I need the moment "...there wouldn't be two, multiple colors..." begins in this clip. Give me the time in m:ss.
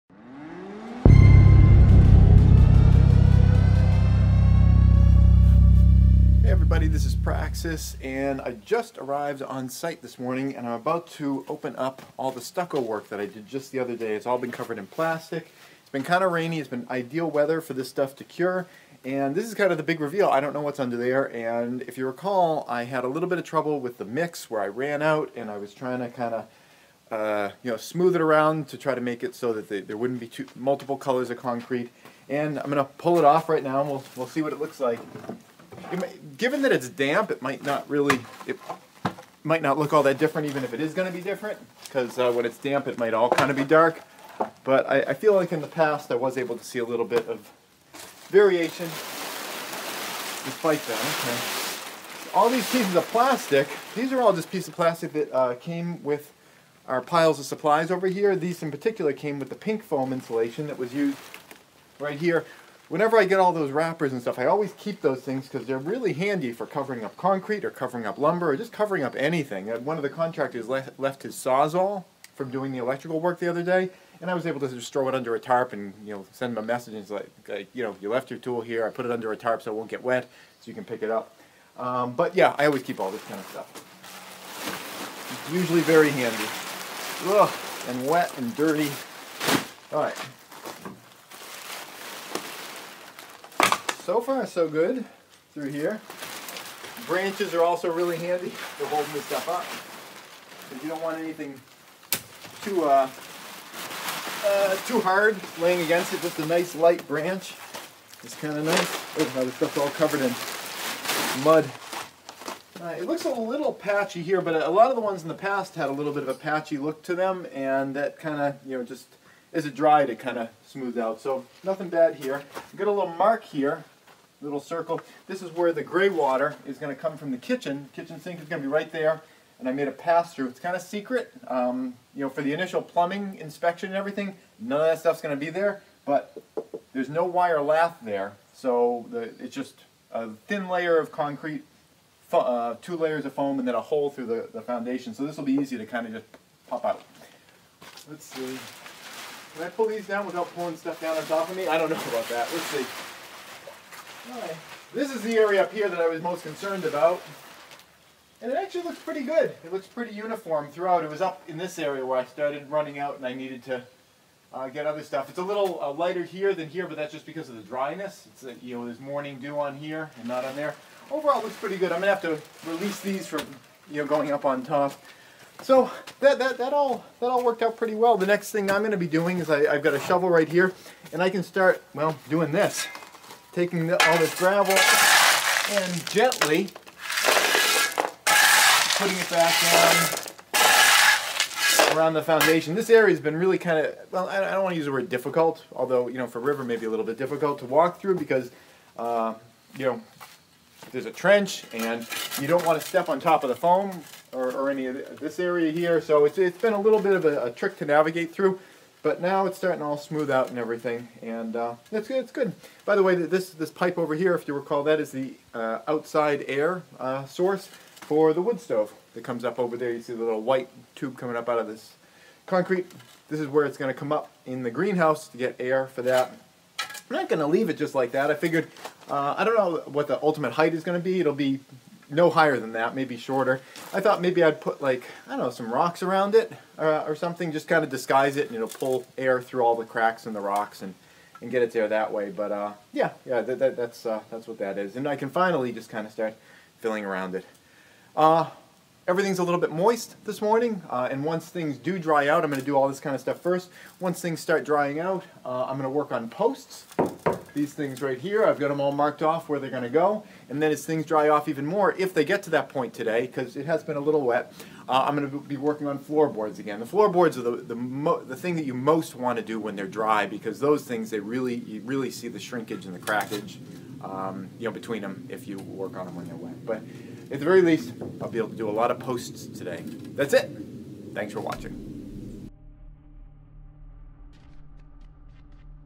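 0:29.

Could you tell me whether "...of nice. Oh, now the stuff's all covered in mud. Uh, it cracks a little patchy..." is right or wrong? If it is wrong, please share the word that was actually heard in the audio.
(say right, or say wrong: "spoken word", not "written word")
wrong: "looks", not "cracks".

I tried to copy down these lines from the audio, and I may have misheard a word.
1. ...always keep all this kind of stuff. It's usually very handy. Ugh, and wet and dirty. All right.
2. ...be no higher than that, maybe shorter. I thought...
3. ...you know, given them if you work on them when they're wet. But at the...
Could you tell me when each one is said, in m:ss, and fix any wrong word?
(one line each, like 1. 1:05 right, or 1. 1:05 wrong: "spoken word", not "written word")
1. 1:22 right
2. 3:51 right
3. 4:34 wrong: "between", not "given".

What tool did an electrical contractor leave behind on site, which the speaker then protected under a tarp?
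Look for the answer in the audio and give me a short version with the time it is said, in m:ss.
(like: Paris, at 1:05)
sawzall, at 1:11.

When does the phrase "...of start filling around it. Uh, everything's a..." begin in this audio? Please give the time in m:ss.
4:06.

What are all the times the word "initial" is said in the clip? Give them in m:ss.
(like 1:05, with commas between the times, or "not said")
2:12.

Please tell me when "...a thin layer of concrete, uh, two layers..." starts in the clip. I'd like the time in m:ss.
2:20.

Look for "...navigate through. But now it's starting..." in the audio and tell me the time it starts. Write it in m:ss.
3:27.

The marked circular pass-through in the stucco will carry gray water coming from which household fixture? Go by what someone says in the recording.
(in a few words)
kitchen sink.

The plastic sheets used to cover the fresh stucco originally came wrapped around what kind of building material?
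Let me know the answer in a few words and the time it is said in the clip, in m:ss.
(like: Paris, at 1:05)
pink foam insulation, at 0:59.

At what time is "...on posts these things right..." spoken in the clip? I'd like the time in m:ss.
4:16.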